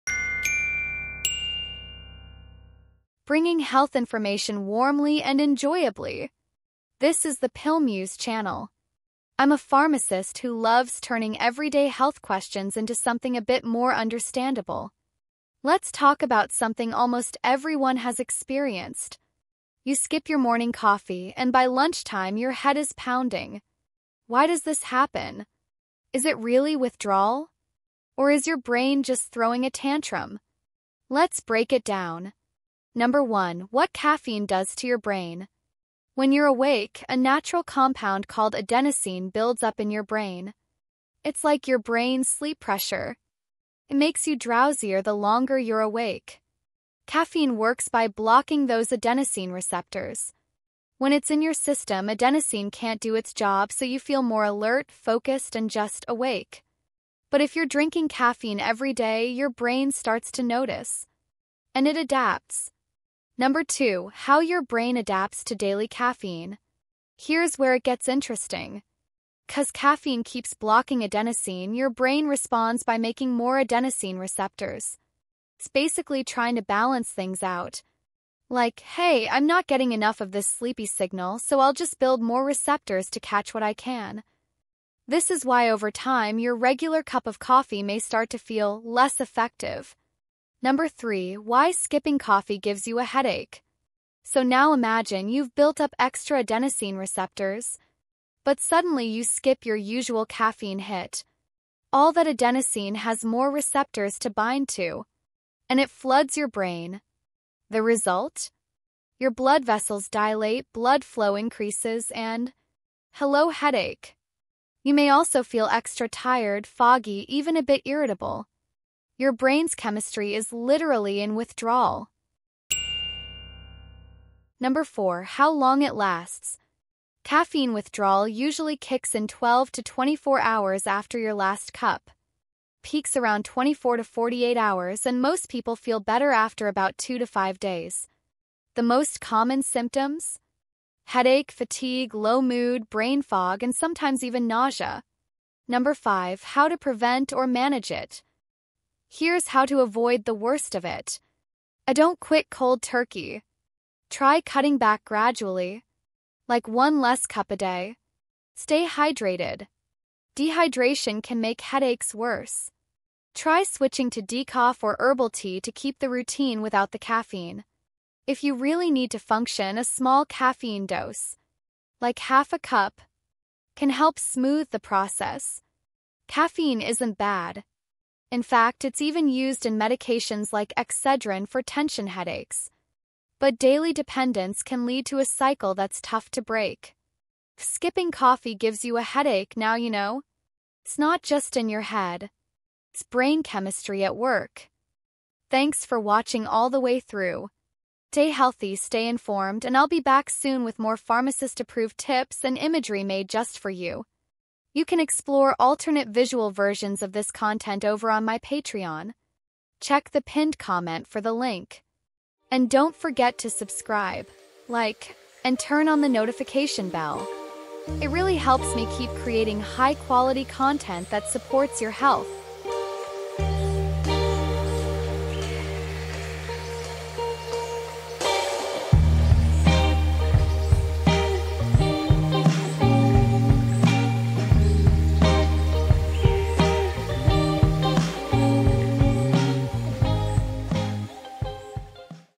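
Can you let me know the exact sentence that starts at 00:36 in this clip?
When you're awake, a natural compound called adenosine builds up in your brain.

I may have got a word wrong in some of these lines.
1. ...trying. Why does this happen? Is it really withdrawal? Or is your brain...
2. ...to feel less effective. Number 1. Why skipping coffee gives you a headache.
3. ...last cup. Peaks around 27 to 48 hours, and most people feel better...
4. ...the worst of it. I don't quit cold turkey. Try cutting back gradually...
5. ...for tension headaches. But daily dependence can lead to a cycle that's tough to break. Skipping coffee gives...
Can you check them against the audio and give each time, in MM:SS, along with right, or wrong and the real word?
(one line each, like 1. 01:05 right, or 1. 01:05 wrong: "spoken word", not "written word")
1. 00:22 wrong: "pounding", not "trying"
2. 01:28 wrong: "3", not "1"
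3. 02:11 wrong: "24", not "27"
4. 02:30 right
5. 03:01 right.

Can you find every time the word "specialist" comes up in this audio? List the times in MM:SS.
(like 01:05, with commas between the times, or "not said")
not said.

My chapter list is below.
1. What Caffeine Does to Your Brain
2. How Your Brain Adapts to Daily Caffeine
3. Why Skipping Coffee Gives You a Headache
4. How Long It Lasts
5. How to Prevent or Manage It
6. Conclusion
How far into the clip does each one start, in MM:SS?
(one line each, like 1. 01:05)
1. 00:33
2. 01:03
3. 01:31
4. 02:05
5. 02:26
6. 02:56.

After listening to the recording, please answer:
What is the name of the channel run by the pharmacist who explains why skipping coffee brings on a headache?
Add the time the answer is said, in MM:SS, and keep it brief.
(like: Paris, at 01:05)
Pill Muse, at 00:07.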